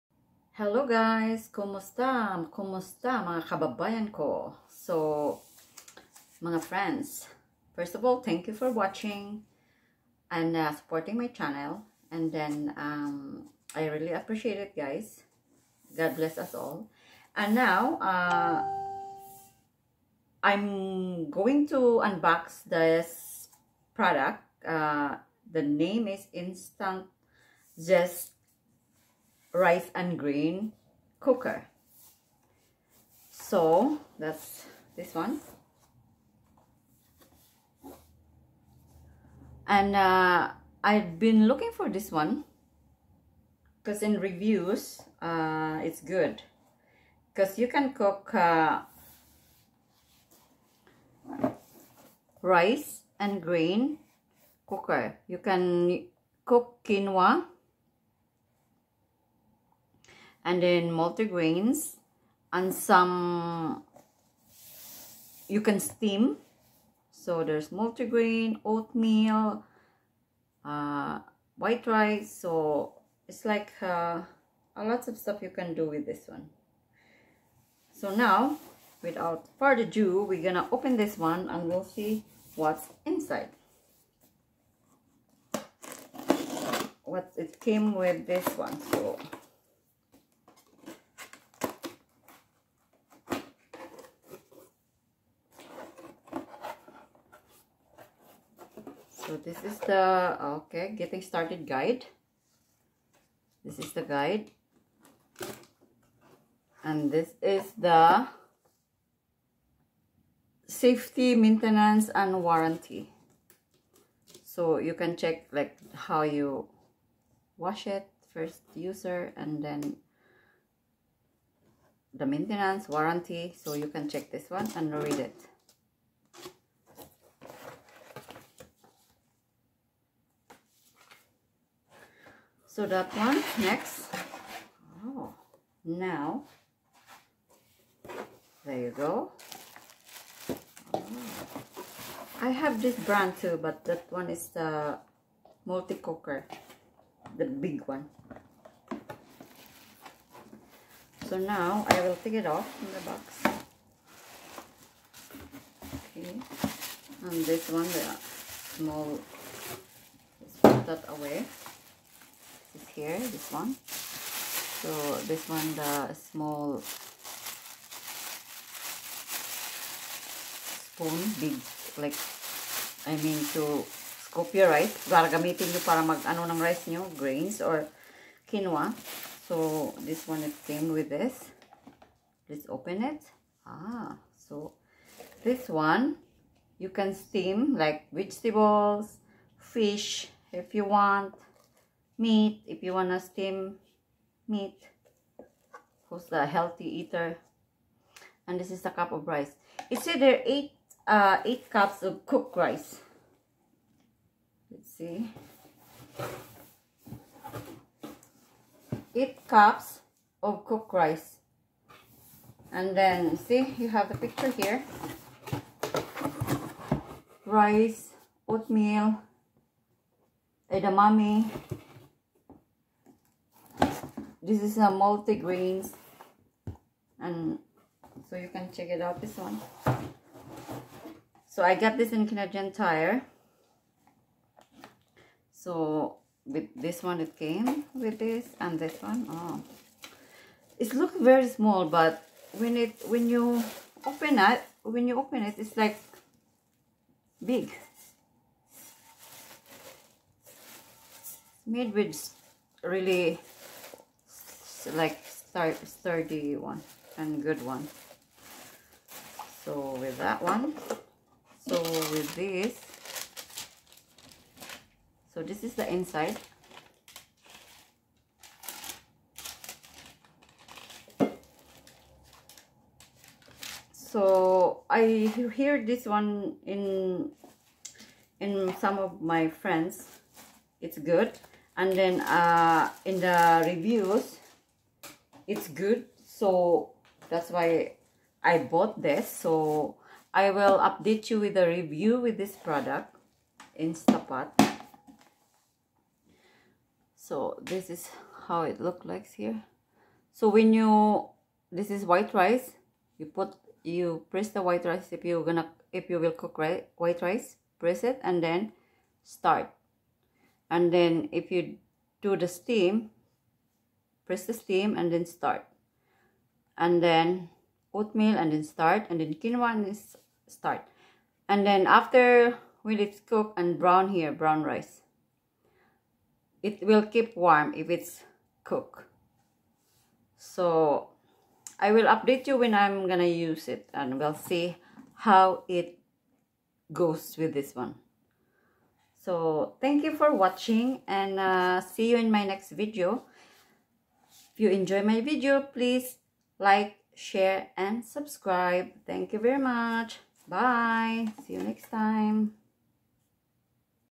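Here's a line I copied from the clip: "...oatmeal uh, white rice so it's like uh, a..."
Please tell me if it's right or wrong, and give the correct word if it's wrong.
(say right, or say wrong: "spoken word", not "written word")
right.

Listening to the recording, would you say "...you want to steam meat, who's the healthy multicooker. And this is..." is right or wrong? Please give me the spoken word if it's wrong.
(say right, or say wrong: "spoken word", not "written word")
wrong: "eater", not "multicooker".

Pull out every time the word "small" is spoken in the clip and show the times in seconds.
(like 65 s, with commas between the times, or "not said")
158 s, 166 s, 241 s.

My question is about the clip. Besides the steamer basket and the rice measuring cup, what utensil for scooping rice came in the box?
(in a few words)
Spoon.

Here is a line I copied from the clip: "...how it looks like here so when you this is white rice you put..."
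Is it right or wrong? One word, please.
right.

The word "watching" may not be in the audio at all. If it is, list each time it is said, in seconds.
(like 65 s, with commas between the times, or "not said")
8 s, 340 s.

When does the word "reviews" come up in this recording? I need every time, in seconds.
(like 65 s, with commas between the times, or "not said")
44 s, 283 s, 291 s.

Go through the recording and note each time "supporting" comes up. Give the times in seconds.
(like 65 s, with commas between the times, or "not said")
10 s.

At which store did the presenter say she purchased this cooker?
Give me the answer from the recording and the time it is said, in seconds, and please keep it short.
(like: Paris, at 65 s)
Canadian Tire, at 232 s.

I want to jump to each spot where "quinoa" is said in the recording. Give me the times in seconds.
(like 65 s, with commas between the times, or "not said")
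56 s, 178 s, 319 s.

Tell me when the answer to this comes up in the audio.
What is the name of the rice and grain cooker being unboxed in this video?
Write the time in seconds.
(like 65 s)
26 s.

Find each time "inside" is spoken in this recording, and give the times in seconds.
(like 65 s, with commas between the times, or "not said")
83 s, 265 s.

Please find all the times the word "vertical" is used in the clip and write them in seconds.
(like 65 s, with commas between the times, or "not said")
not said.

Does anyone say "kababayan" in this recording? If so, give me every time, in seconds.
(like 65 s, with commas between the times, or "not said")
3 s.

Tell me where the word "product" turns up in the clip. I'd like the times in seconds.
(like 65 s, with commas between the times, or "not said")
23 s, 292 s.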